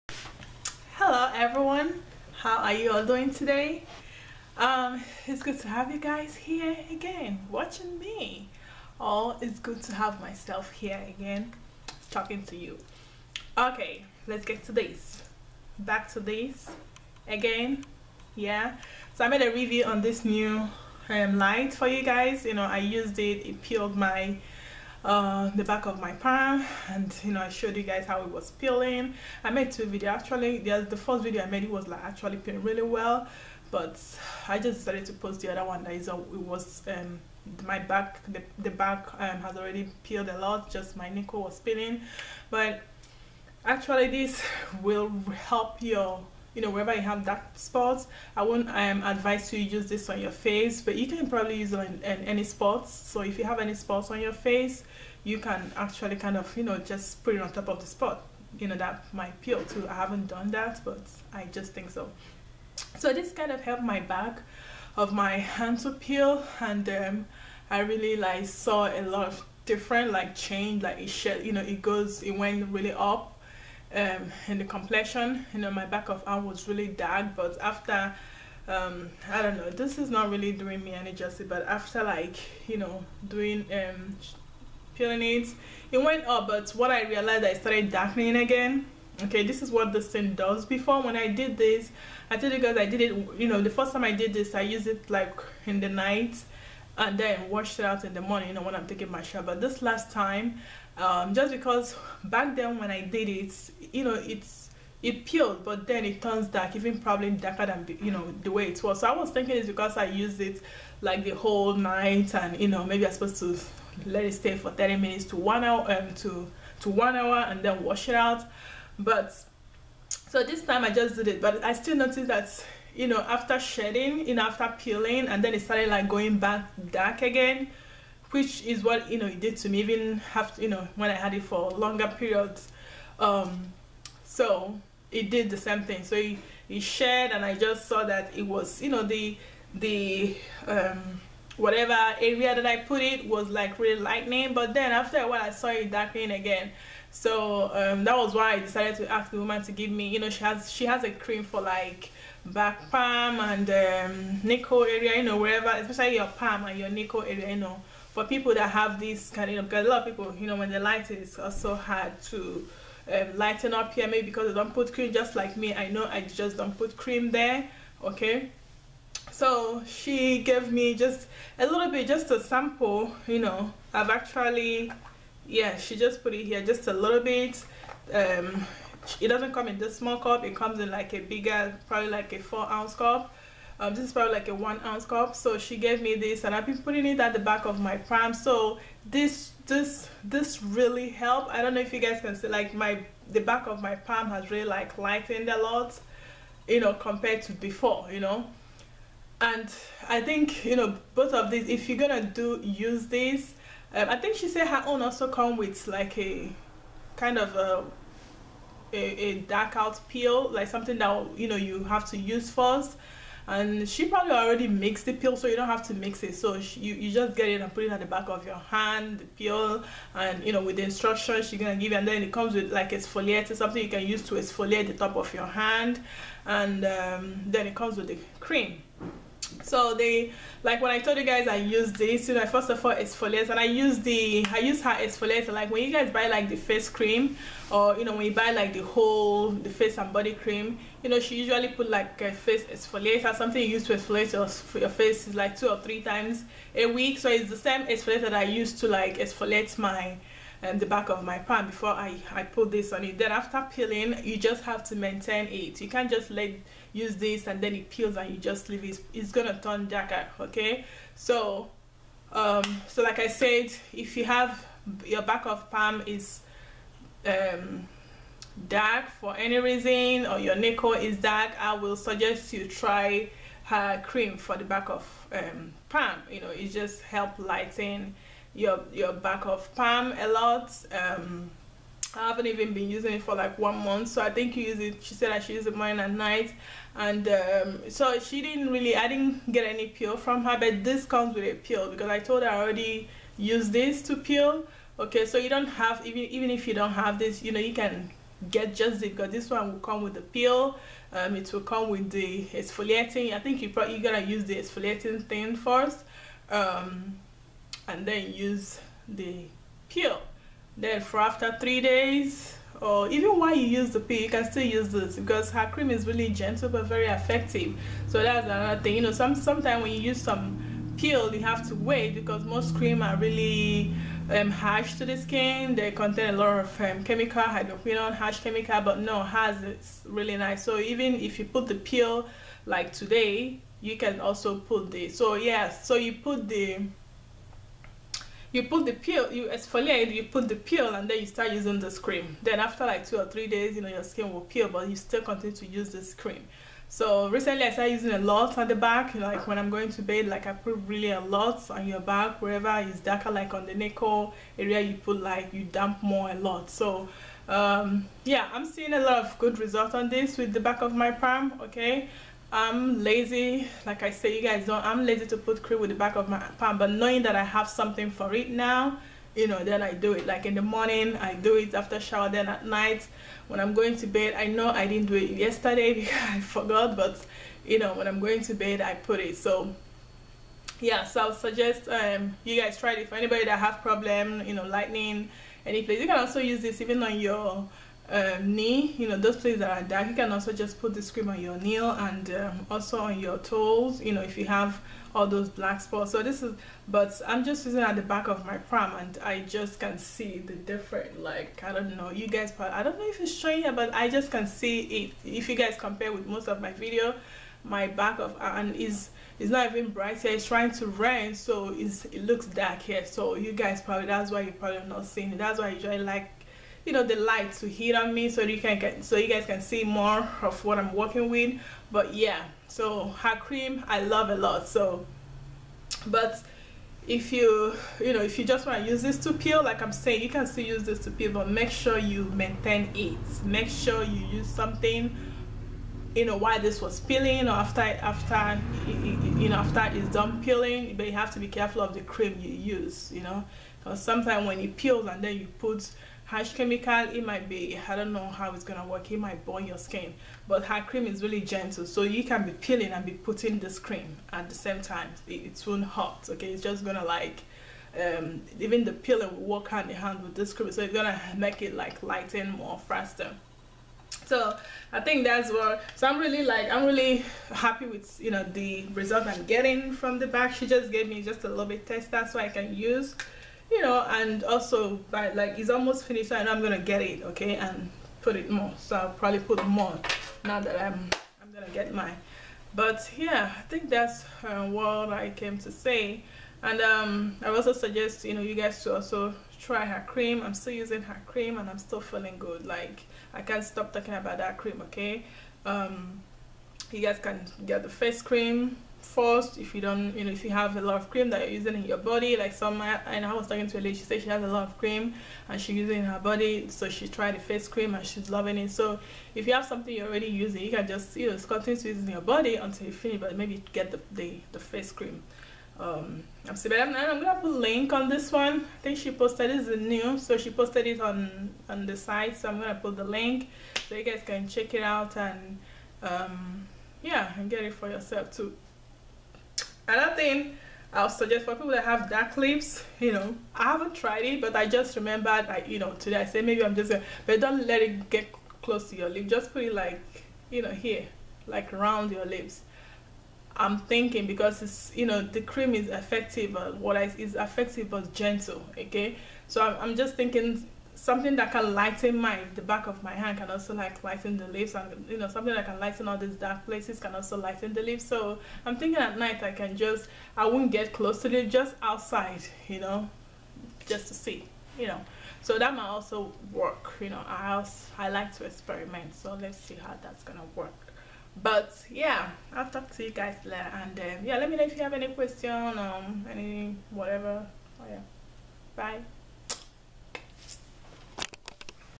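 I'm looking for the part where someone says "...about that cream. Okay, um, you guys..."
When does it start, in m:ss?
8:14.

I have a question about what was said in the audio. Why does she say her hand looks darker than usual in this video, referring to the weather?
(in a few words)
it's trying to rain.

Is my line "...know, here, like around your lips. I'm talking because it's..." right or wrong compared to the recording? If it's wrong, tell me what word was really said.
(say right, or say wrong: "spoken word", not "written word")
wrong: "thinking", not "talking".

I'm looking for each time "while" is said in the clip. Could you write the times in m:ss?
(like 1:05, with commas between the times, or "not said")
2:25, 5:13.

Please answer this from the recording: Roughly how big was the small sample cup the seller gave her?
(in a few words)
1 ounce.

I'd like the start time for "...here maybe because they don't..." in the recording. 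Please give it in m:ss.
2:43.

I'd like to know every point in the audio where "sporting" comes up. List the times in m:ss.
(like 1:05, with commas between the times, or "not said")
not said.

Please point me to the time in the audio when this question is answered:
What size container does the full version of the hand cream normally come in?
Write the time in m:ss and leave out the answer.
3:02.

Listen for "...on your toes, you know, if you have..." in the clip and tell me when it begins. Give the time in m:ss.
6:32.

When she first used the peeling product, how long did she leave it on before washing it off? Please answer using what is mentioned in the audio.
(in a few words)
the night.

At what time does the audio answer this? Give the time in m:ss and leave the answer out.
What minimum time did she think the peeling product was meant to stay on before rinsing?
1:54.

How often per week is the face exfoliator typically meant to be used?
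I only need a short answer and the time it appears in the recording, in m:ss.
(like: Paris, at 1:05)
two or three times, at 4:05.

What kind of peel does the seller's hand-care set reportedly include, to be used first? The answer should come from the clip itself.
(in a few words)
dark out peel.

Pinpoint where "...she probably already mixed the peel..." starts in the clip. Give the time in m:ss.
3:33.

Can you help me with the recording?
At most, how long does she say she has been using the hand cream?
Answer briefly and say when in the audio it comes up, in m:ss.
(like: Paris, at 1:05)
one month, at 4:43.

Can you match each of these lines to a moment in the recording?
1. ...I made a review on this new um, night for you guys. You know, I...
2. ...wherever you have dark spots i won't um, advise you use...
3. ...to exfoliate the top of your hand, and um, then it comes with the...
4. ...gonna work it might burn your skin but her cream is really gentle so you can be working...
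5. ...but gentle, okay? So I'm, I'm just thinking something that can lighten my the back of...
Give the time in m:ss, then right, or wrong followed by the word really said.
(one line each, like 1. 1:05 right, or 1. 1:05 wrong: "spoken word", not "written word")
1. 0:19 wrong: "light", not "night"
2. 0:46 right
3. 3:44 right
4. 7:28 wrong: "peeling", not "working"
5. 9:07 right.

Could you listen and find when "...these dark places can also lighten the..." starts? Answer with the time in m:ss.
9:16.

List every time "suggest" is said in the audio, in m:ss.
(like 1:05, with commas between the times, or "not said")
4:31, 6:21, 8:07, 8:51.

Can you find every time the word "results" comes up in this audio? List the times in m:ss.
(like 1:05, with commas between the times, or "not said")
5:59, 7:48.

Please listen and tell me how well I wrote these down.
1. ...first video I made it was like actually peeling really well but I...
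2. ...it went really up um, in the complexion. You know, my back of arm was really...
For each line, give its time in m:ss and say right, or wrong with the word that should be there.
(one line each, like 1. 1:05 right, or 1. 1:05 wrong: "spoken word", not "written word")
1. 0:30 right
2. 1:12 right.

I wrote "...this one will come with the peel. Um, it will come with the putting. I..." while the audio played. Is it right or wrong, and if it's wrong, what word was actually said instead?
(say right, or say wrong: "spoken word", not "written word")
wrong: "exfoliating", not "putting".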